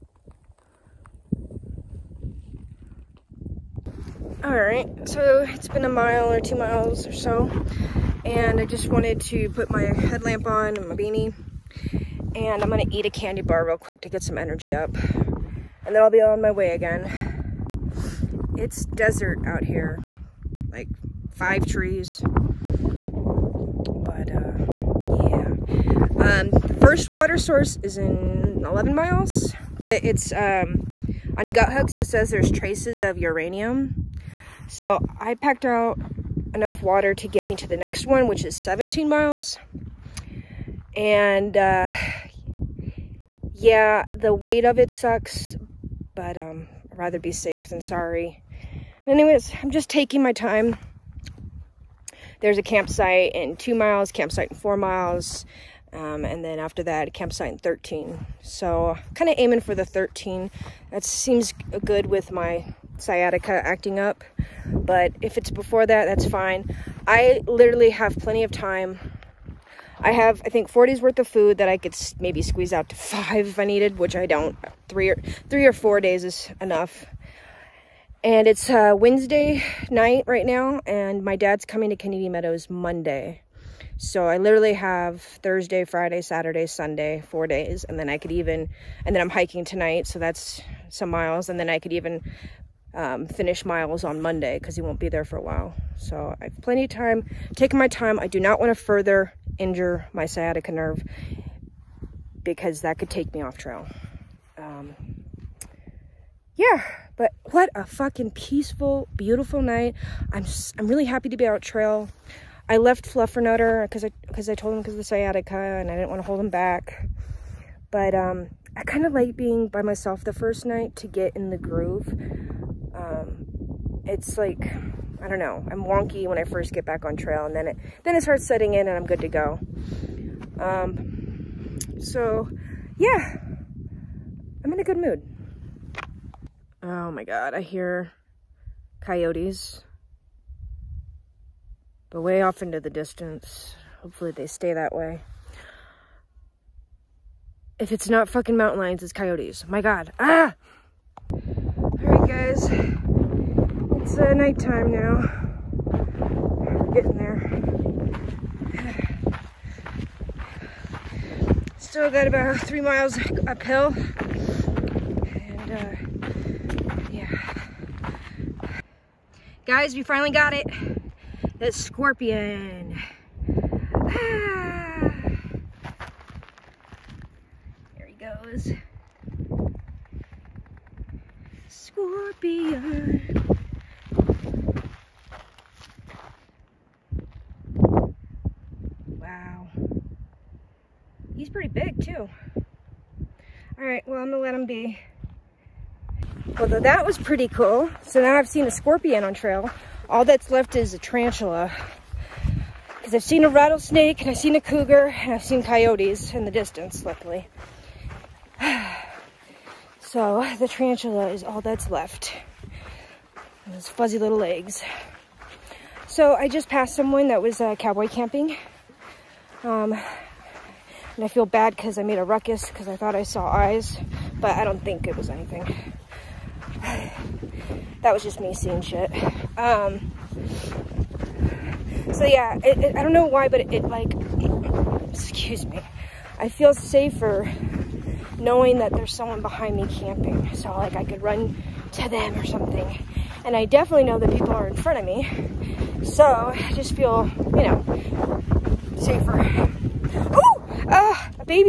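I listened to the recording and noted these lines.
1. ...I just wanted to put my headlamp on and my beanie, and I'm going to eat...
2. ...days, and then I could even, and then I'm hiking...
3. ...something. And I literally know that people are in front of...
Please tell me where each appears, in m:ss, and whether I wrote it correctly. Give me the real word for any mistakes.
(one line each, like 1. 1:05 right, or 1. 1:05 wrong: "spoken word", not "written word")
1. 0:08 right
2. 1:27 right
3. 4:02 wrong: "definitely", not "literally".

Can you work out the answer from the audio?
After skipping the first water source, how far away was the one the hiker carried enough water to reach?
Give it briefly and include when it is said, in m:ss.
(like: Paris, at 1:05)
17 miles, at 0:38.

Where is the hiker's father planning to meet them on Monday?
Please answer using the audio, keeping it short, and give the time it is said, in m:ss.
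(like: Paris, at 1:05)
Kennedy Meadows, at 1:21.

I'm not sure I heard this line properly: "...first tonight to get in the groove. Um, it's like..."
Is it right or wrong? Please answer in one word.
wrong.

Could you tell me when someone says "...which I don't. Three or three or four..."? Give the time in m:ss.
1:13.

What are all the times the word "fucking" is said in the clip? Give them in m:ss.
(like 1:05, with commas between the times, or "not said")
1:47, 2:28.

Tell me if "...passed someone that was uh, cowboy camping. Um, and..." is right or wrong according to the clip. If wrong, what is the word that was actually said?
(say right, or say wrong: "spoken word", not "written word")
right.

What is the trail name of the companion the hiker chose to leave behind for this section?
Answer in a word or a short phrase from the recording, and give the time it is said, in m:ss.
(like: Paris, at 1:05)
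Fluffernutter, at 1:53.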